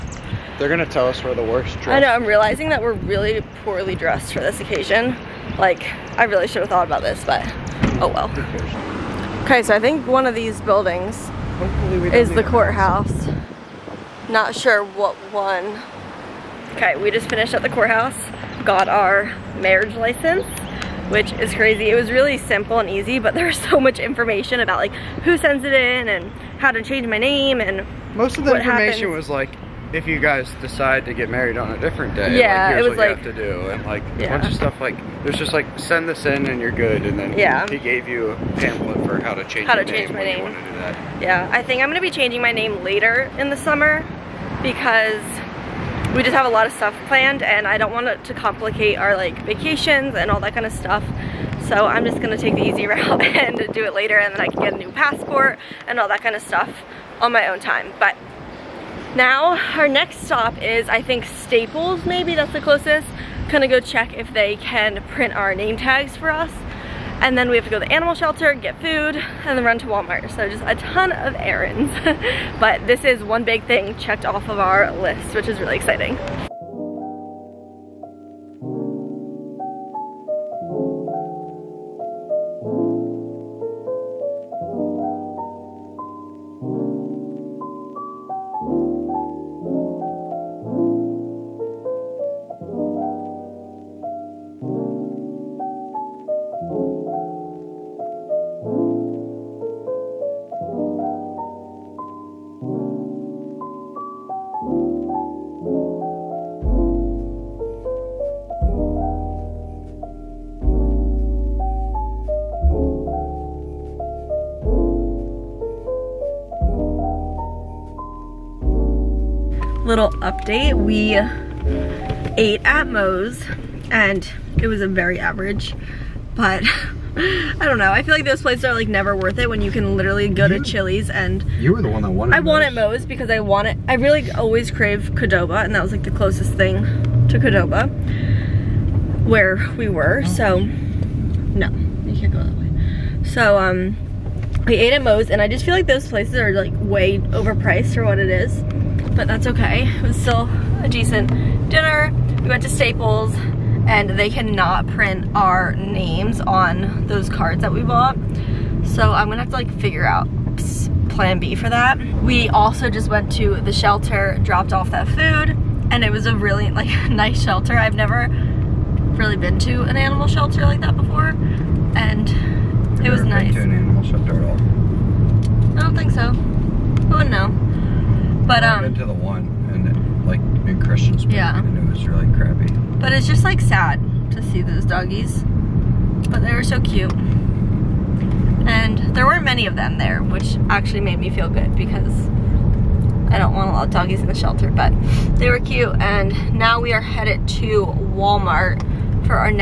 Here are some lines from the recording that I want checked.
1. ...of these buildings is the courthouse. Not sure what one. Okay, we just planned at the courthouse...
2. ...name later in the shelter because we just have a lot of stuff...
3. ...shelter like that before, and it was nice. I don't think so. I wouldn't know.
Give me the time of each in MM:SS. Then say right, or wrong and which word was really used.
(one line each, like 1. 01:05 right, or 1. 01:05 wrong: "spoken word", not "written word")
1. 00:10 wrong: "finished", not "planned"
2. 00:42 wrong: "summer", not "shelter"
3. 02:50 right.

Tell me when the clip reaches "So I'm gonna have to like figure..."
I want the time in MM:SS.
02:38.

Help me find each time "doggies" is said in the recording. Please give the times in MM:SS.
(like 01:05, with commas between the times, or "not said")
03:04, 03:13.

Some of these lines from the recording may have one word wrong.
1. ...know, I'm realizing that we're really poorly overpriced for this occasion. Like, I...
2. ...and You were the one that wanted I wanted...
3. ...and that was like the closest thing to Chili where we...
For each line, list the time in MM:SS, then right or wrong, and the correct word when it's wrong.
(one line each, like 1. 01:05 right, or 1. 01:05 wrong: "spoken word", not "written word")
1. 00:01 wrong: "dressed", not "overpriced"
2. 02:11 right
3. 02:15 wrong: "Qdoba", not "Chili".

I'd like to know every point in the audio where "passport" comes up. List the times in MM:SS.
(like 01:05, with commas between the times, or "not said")
00:54.